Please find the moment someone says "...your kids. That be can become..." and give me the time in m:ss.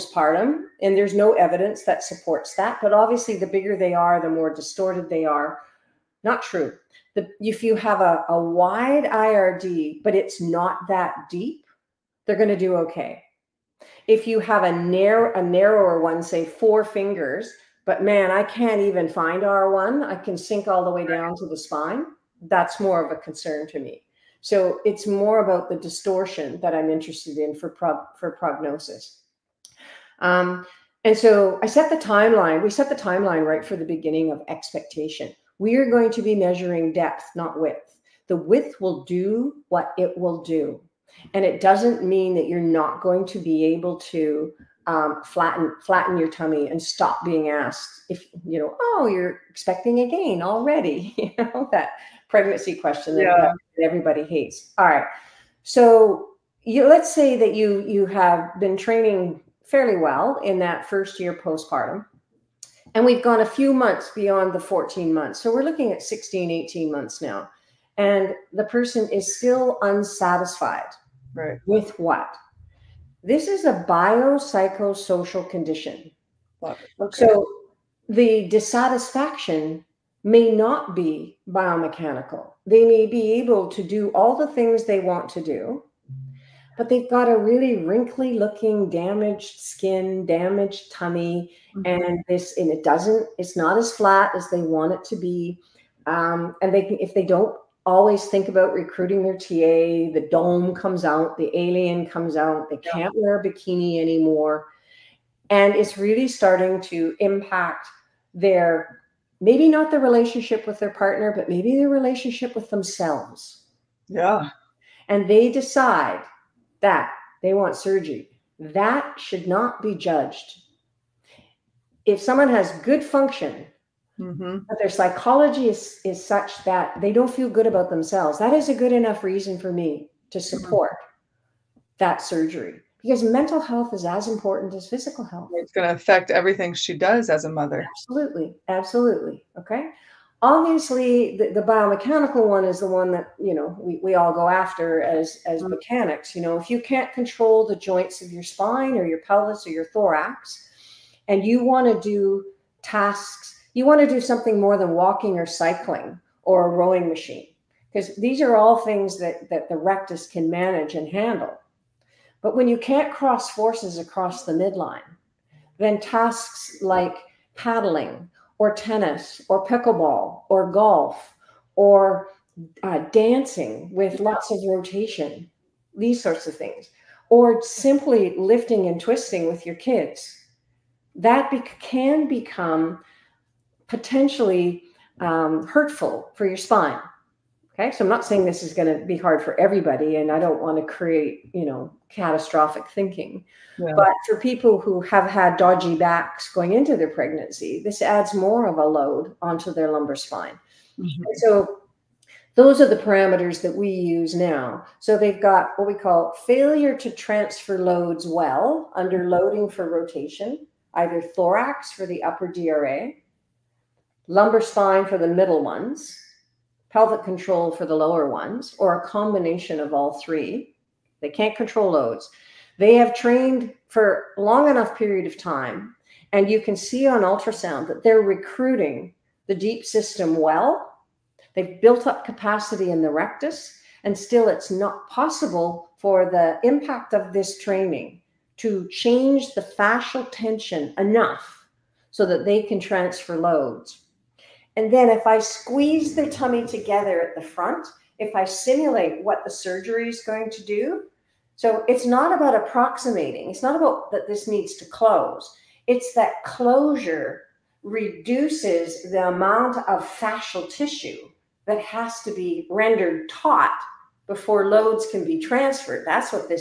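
2:59.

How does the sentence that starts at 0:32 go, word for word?
We set the timeline right for the beginning of expectation.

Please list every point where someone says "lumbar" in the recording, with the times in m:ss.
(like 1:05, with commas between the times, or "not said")
3:19, 3:34.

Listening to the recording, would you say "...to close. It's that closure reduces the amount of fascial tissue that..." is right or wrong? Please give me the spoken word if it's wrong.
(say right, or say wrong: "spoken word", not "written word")
right.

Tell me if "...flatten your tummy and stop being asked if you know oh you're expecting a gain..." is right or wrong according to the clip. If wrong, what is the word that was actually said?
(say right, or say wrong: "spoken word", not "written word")
right.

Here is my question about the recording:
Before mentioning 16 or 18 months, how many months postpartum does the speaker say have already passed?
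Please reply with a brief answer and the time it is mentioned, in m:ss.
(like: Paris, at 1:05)
14 months, at 1:04.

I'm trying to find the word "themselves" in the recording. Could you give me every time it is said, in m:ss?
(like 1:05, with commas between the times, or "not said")
1:52, 2:07.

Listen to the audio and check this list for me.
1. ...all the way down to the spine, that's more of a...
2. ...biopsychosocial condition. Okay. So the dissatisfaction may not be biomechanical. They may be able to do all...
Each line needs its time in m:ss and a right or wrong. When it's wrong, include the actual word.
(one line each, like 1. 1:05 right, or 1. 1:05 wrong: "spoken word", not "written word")
1. 0:20 right
2. 1:13 right.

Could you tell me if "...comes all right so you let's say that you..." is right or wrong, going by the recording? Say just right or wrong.
wrong.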